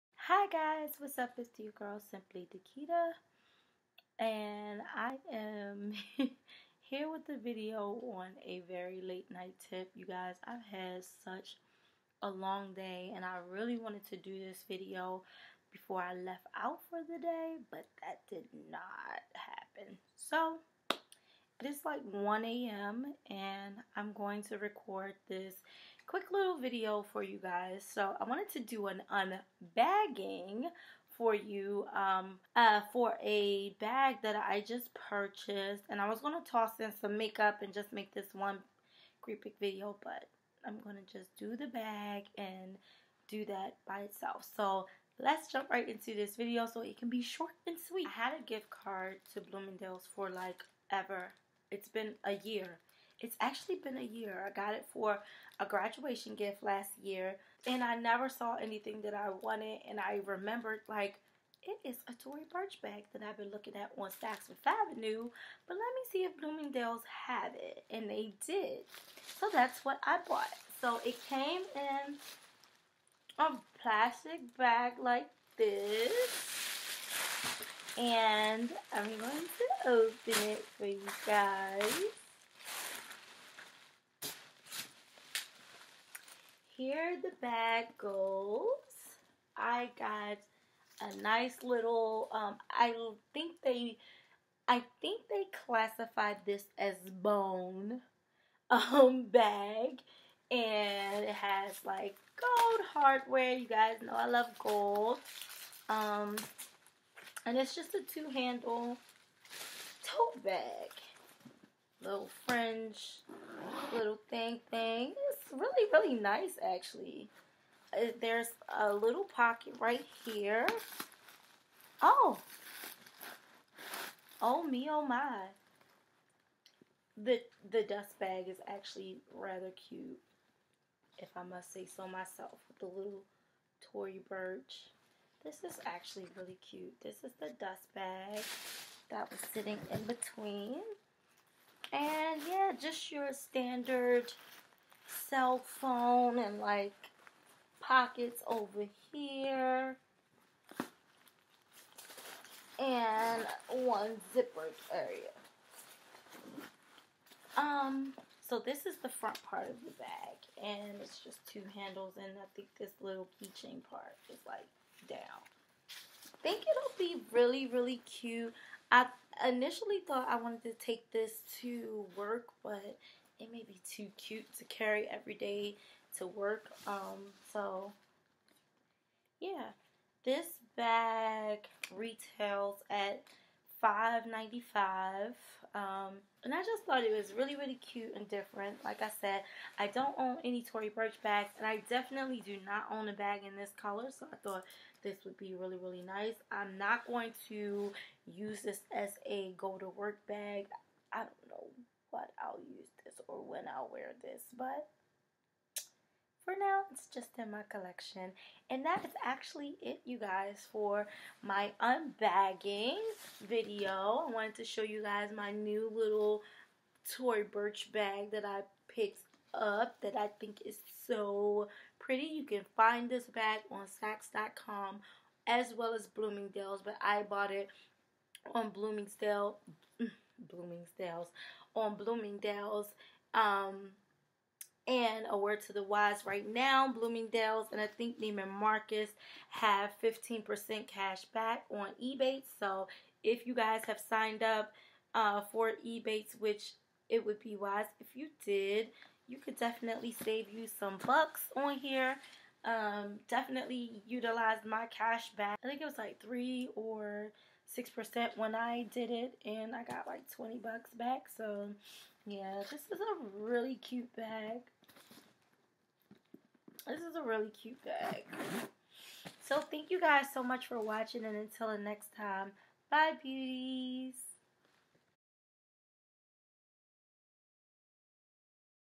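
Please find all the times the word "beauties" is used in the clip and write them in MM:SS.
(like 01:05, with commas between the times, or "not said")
04:33.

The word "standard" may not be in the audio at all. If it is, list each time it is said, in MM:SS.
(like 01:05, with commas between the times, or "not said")
02:23.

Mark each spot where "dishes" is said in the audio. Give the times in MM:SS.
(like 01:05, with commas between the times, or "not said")
not said.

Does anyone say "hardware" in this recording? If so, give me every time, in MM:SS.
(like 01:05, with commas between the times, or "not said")
01:42.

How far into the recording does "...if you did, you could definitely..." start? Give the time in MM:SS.
04:07.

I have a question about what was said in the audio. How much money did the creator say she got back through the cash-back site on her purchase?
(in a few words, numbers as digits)
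$20.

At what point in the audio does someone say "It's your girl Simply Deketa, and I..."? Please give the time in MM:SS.
00:01.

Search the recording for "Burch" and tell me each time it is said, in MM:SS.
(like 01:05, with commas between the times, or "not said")
01:02, 02:14, 03:10.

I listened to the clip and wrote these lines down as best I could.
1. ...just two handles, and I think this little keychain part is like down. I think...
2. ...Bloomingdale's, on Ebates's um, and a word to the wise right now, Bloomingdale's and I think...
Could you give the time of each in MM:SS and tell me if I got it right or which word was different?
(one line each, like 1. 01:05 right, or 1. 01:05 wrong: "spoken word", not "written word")
1. 02:41 right
2. 03:50 wrong: "Bloomingdale", not "Ebates".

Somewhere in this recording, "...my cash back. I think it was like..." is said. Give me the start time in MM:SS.
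04:14.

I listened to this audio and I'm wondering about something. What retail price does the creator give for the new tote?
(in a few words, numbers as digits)
$595.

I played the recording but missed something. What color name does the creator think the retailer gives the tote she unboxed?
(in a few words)
Bone.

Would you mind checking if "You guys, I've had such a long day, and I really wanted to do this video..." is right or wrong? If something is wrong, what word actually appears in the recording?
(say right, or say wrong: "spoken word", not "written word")
right.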